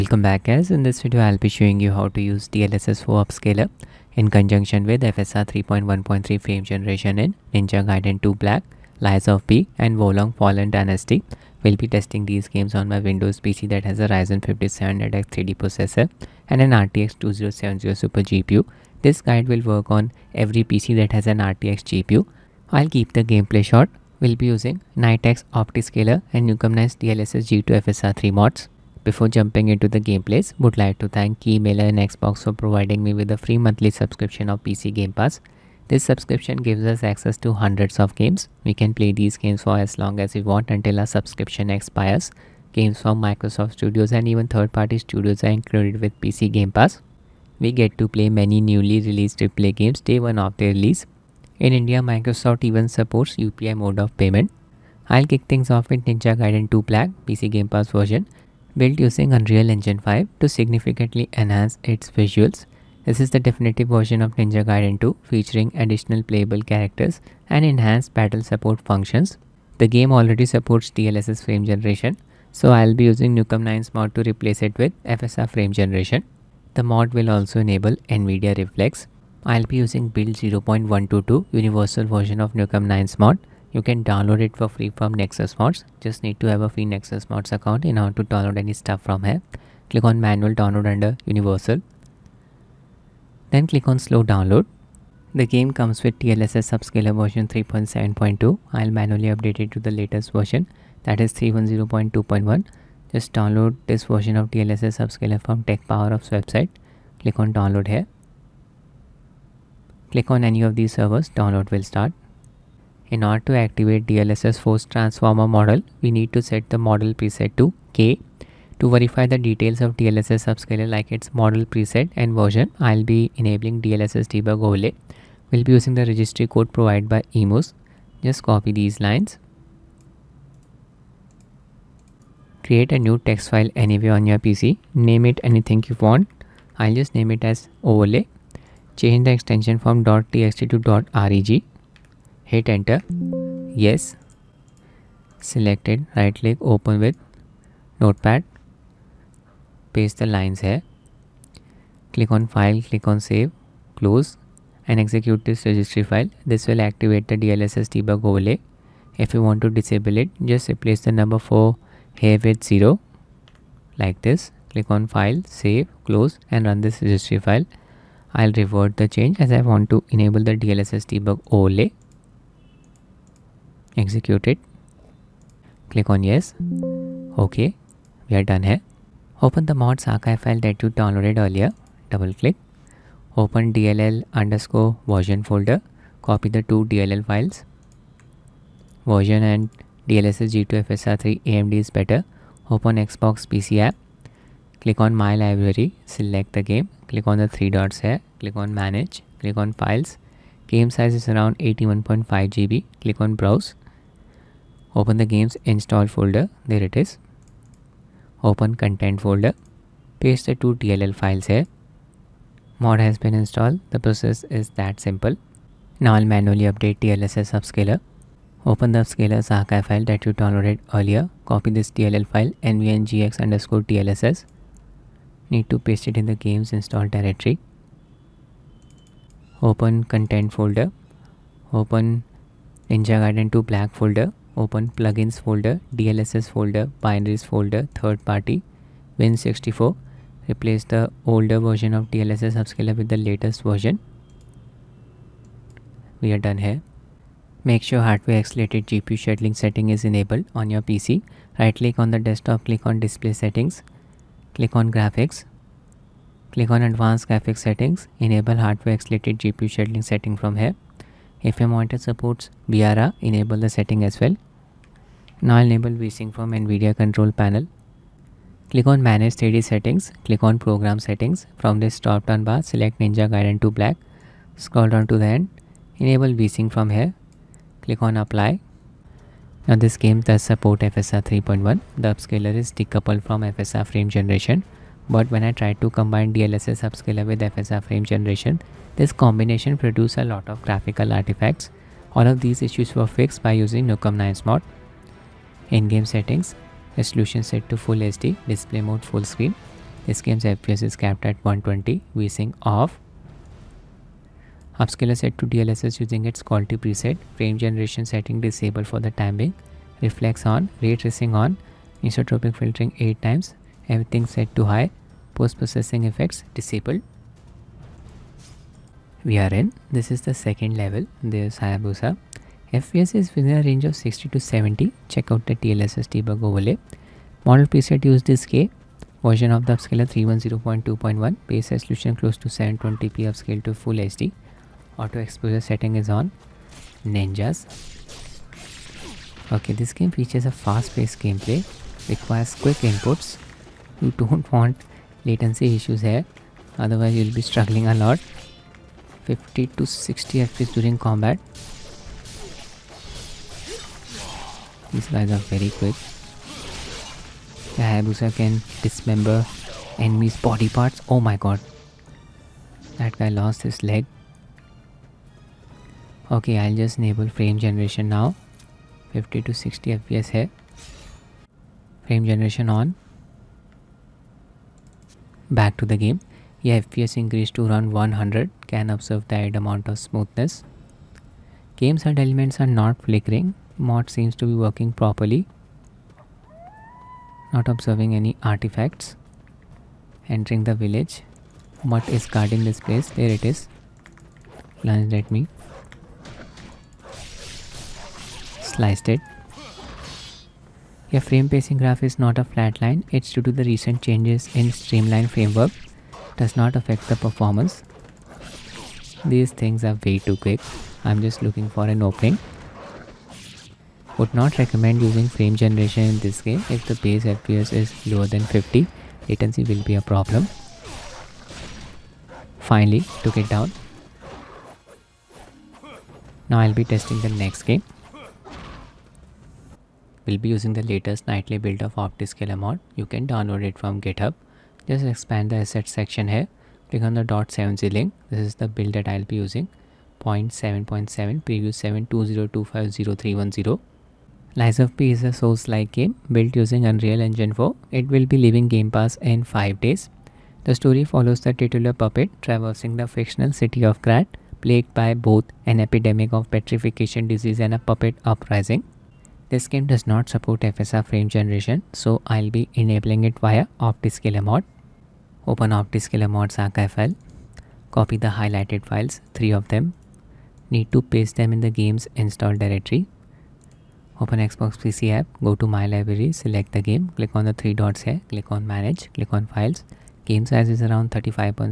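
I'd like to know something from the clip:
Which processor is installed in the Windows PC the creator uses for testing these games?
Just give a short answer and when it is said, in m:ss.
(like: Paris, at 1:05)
Ryzen 5700X 3D, at 0:14.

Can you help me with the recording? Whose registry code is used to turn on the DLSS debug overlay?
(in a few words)
emoose.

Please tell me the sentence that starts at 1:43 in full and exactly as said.
Just download this version of DLSS upscaler from TechPowerUp's website.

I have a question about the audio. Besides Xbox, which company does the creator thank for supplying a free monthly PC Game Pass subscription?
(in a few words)
Keymailer.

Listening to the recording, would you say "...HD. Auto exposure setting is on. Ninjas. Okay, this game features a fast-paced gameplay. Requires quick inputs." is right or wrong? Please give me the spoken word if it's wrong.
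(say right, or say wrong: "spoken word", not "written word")
right.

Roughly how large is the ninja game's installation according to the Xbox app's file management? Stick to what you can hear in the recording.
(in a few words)
81.5 GB.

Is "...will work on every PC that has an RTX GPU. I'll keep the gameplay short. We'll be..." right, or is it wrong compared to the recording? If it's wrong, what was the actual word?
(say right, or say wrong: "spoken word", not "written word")
right.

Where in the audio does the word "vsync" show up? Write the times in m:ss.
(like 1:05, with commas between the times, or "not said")
4:25, 4:36, 5:02.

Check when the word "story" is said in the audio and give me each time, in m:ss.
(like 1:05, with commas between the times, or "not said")
7:30.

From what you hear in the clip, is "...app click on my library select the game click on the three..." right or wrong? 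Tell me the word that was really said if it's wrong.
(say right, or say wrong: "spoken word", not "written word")
right.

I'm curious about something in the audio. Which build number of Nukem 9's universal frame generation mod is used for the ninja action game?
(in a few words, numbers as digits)
0.122.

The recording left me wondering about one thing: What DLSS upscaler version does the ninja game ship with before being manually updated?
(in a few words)
3.7.2.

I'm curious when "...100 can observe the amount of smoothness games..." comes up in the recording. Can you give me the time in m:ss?
6:18.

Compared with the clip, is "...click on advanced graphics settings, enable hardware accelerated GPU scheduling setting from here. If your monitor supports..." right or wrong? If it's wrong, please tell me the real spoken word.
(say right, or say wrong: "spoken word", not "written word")
right.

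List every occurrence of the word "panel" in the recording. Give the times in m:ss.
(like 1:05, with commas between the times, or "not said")
4:27.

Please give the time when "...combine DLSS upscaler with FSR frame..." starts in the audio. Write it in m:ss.
4:45.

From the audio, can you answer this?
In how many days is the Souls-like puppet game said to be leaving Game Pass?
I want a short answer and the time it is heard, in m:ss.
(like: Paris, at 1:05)
5, at 7:29.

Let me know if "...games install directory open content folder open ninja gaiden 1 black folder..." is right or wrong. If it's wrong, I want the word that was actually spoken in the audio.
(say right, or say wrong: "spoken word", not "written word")
wrong: "2", not "1".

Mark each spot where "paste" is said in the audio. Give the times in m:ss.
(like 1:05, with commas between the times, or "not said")
2:29, 3:30, 3:45, 7:51.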